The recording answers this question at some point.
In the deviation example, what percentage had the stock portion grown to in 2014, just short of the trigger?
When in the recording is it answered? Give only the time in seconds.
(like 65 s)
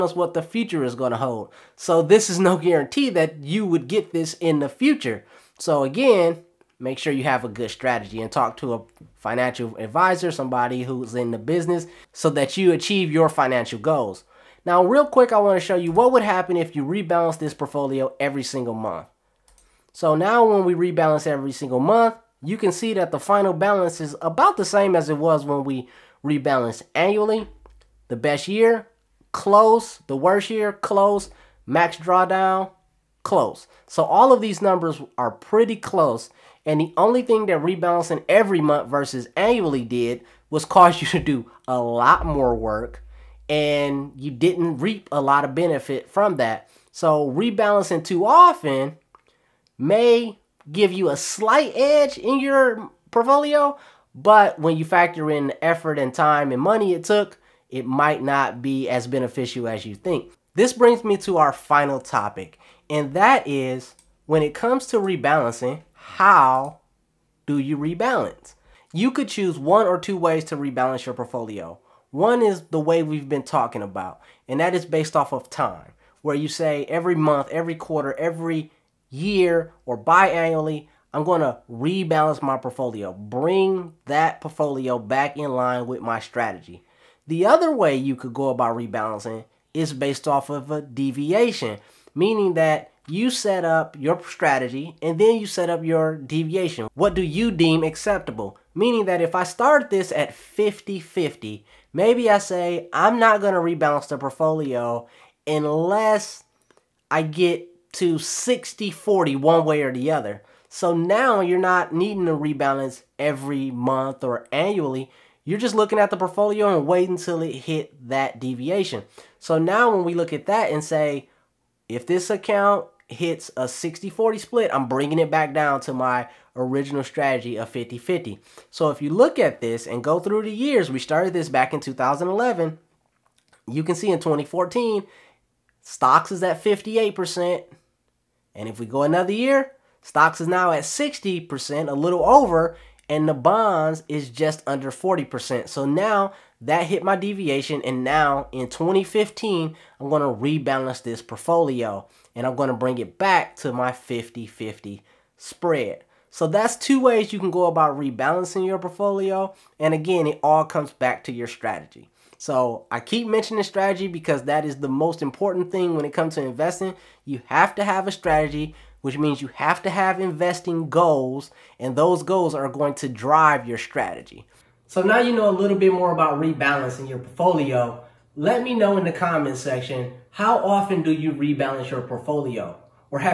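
136 s.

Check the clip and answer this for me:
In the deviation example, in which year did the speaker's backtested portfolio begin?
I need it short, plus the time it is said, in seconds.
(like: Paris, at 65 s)
2011, at 131 s.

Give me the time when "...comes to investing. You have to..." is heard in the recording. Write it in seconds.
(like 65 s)
166 s.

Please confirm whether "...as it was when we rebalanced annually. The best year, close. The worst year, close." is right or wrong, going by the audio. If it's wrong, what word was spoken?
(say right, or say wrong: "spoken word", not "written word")
right.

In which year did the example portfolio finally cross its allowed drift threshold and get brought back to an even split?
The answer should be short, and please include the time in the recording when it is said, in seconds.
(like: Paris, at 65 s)
2015, at 148 s.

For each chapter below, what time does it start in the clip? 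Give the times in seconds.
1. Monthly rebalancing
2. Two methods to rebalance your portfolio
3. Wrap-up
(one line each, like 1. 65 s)
1. 14 s
2. 59 s
3. 174 s.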